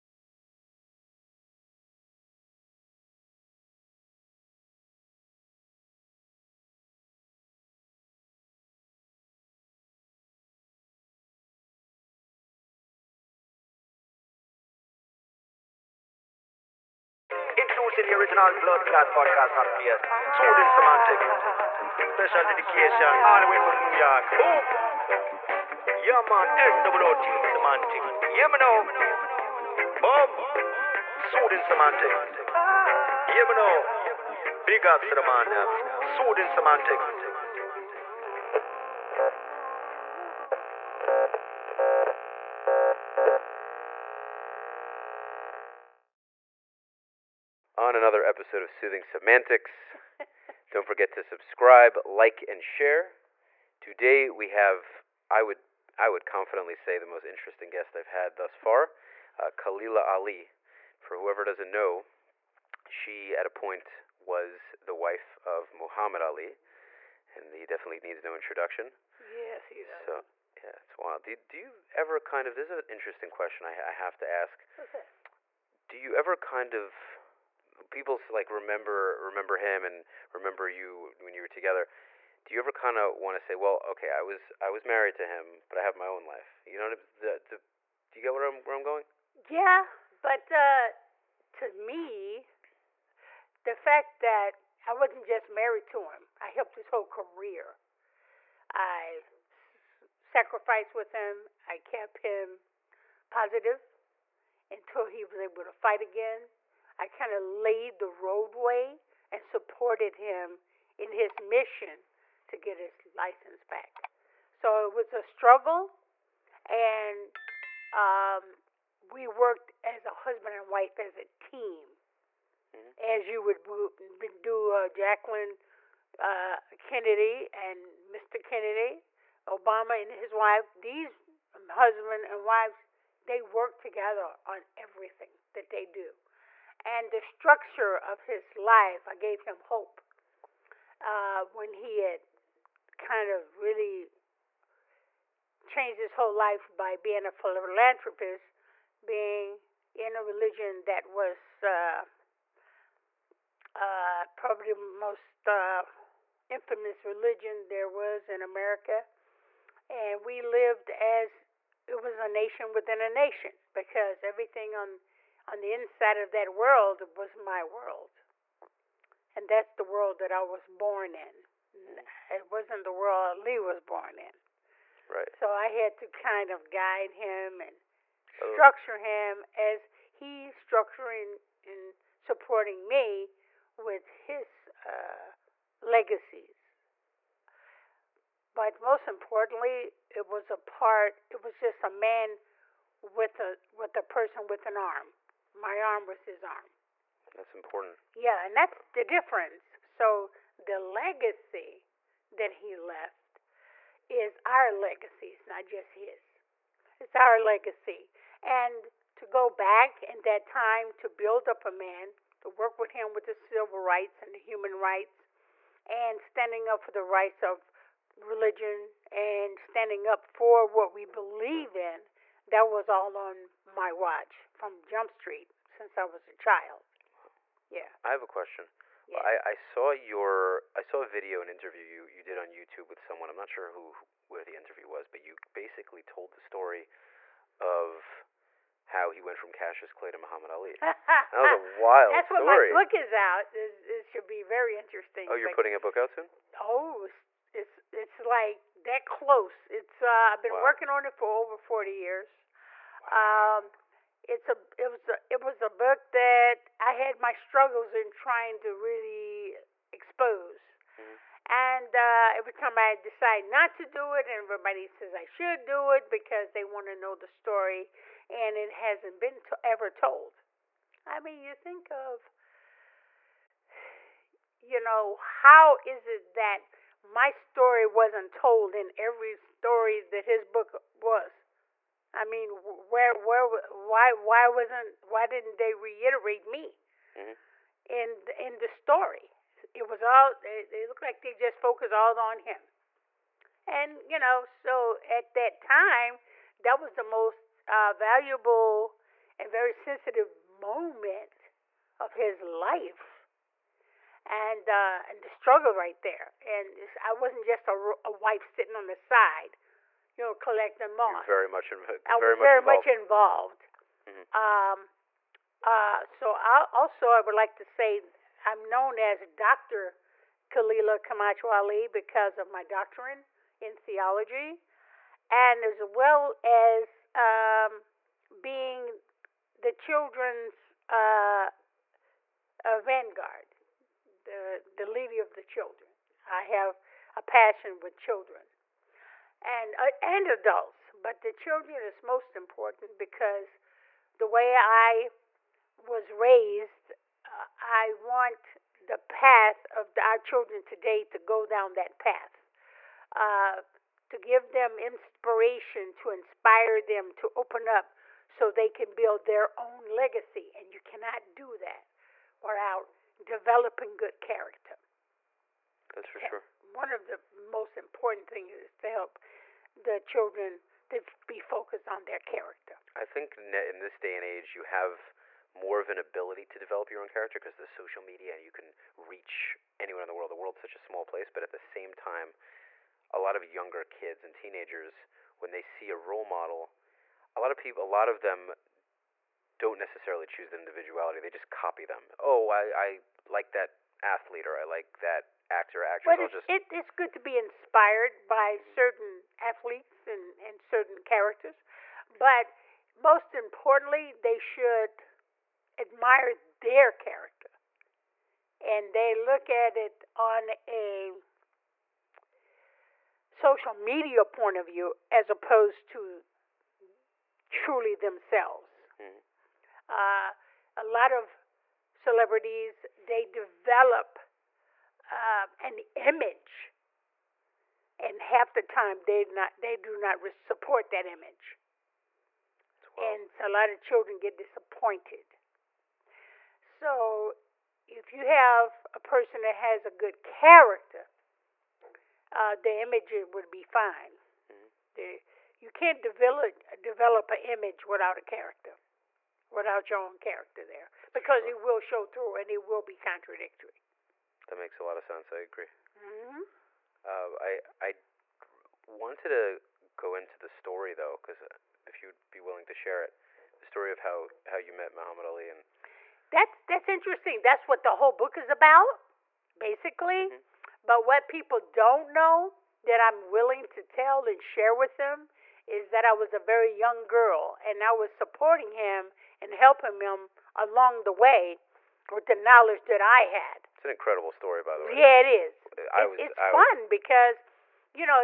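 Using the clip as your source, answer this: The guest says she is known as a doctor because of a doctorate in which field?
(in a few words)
Theology.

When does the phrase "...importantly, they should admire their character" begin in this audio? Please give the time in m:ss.
6:43.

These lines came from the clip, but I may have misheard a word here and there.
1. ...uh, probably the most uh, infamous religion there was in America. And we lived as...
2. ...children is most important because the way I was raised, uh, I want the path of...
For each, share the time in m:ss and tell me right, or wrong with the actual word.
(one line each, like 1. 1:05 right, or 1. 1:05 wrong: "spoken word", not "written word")
1. 2:33 right
2. 5:41 right.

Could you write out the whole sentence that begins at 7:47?
That's what the whole book is about, basically.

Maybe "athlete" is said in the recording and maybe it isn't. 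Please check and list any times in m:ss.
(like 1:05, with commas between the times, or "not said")
6:34, 6:39.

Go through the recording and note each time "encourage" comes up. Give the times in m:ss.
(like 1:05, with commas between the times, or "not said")
not said.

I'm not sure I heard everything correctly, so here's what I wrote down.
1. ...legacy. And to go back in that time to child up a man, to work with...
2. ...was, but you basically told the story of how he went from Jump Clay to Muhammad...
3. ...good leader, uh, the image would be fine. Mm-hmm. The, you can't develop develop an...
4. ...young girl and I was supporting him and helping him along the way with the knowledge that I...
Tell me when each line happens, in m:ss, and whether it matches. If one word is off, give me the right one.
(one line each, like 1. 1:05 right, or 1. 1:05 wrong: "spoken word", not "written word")
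1. 3:27 wrong: "build", not "child"
2. 3:54 wrong: "Cassius", not "Jump"
3. 7:19 wrong: "character", not "leader"
4. 7:56 right.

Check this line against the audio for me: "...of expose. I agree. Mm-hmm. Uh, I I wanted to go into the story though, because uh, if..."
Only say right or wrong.
wrong.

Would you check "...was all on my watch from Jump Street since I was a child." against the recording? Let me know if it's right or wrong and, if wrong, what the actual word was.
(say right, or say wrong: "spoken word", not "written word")
right.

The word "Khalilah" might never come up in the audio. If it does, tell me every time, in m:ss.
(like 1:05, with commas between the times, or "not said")
0:59, 5:20.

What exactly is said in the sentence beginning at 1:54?
So it was a struggle, and um, we worked as a husband and wife as a team, mm-hmm.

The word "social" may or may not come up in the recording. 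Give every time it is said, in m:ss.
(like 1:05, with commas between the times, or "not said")
6:17, 6:53.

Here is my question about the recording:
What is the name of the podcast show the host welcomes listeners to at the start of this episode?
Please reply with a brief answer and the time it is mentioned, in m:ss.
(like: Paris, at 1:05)
Soothing Semantics, at 0:48.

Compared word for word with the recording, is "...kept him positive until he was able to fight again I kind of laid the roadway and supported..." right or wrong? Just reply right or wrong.
right.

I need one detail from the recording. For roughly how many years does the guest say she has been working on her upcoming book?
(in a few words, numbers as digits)
40.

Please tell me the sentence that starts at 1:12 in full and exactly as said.
This is an interesting question I, I have to ask.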